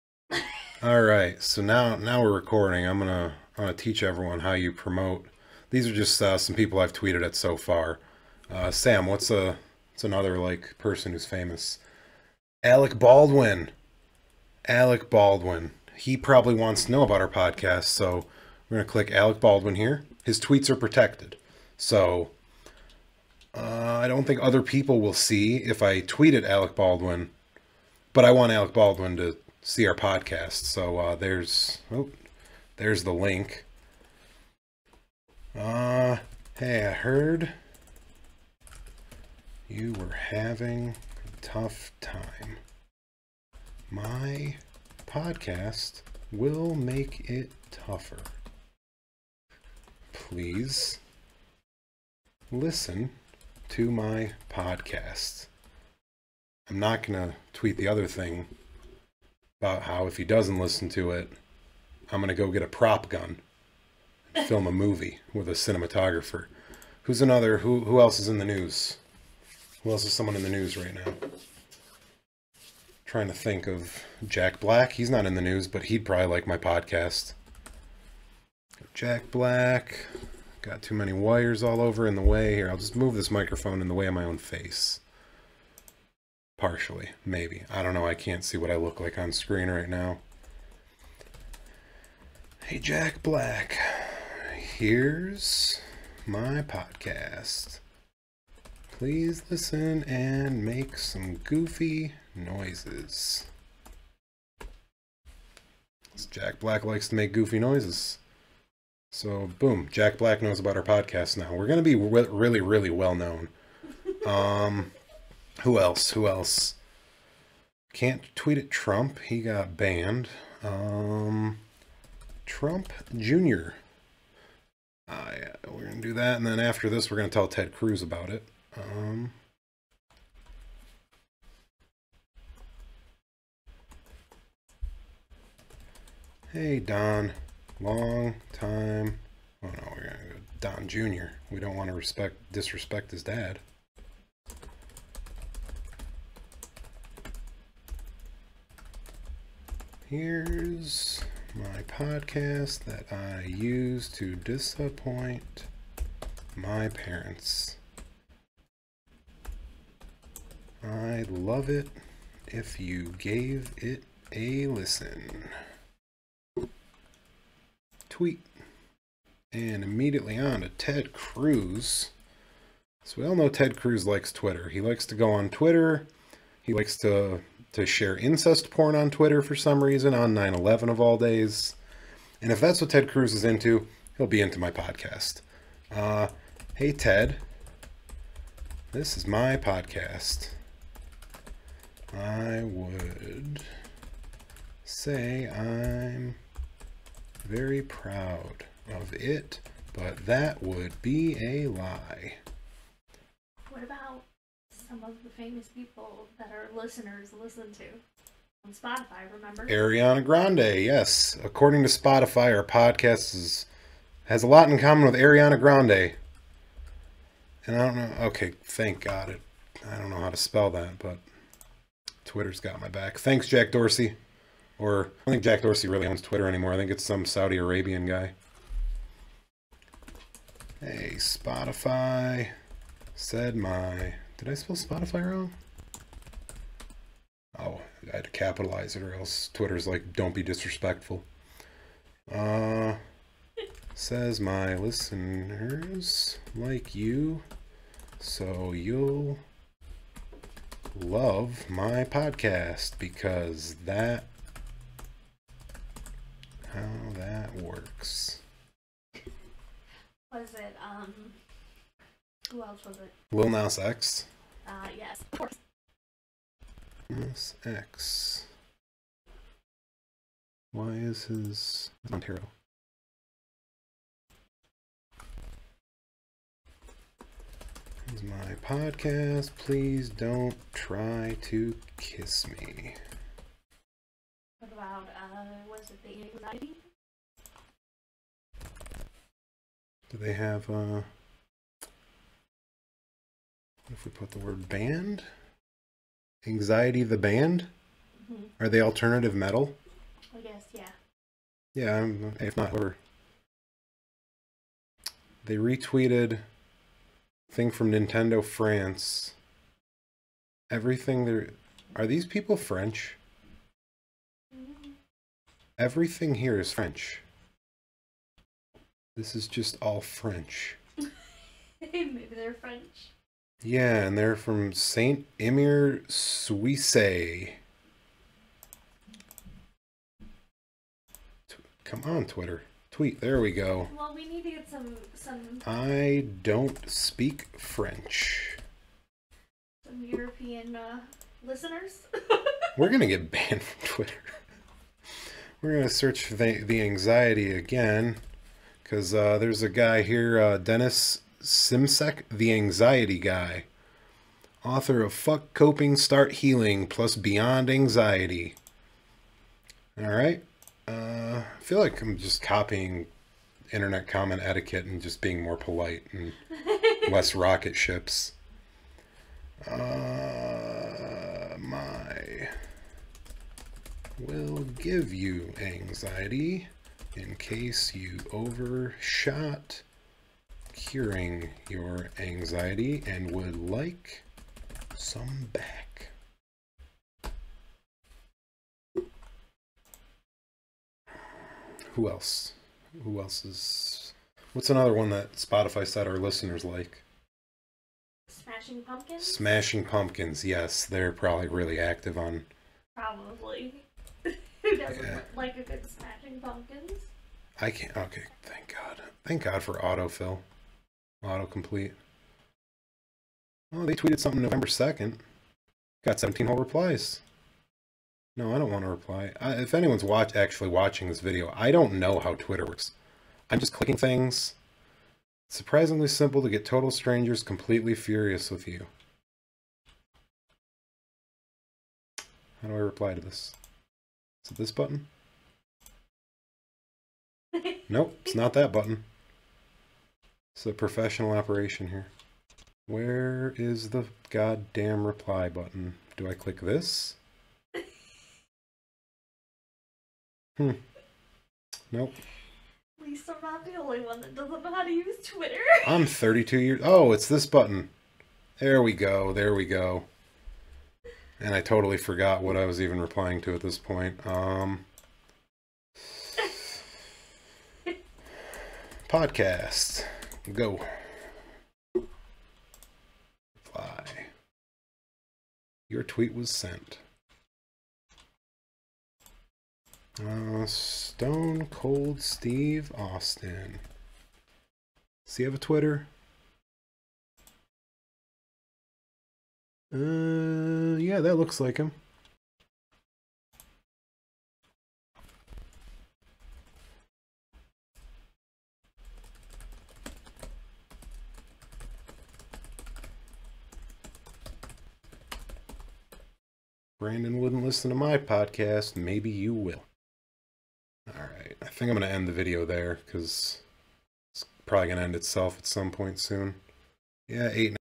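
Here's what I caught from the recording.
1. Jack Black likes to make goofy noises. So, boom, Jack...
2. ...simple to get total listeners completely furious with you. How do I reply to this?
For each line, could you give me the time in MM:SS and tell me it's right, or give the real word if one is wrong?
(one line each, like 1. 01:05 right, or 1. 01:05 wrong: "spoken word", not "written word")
1. 01:46 right
2. 07:06 wrong: "strangers", not "listeners".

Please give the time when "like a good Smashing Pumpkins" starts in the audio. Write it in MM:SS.
06:45.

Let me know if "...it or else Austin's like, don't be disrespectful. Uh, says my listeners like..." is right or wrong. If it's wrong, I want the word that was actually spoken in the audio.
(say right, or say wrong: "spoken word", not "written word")
wrong: "Twitter", not "Austin".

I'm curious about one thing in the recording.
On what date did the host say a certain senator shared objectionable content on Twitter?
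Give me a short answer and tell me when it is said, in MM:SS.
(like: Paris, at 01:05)
9/11, at 03:00.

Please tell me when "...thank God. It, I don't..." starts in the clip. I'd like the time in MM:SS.
03:38.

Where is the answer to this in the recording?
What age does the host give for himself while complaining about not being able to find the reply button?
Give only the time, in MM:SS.
07:36.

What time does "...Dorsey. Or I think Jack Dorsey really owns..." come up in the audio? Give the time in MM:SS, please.
03:43.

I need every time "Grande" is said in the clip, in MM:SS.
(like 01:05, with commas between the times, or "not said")
03:30, 03:35.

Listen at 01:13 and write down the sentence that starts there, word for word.
trying to think of Jack Black.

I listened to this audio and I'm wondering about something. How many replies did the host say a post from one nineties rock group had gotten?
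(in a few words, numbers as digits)
17.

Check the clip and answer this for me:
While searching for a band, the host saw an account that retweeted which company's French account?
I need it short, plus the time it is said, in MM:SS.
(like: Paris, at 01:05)
Nintendo, at 05:07.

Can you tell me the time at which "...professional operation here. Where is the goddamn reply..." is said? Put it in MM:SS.
07:20.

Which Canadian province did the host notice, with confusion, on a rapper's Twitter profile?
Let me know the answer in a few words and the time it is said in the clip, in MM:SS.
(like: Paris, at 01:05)
Ontario, at 04:32.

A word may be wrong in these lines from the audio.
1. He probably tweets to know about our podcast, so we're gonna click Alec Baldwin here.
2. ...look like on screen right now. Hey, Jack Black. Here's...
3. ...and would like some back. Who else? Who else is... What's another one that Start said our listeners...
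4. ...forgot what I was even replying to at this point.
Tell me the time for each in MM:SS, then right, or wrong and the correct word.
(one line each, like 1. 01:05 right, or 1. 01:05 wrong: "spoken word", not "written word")
1. 00:15 wrong: "wants", not "tweets"
2. 01:28 right
3. 06:23 wrong: "Spotify", not "Start"
4. 07:41 right.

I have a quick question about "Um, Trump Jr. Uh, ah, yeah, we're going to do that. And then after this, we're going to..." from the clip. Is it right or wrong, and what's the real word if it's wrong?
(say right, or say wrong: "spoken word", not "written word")
right.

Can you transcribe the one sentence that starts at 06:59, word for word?
I, if anyone's watch actually watching this video, I don't know how Twitter works.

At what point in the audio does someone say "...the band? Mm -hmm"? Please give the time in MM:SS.
04:57.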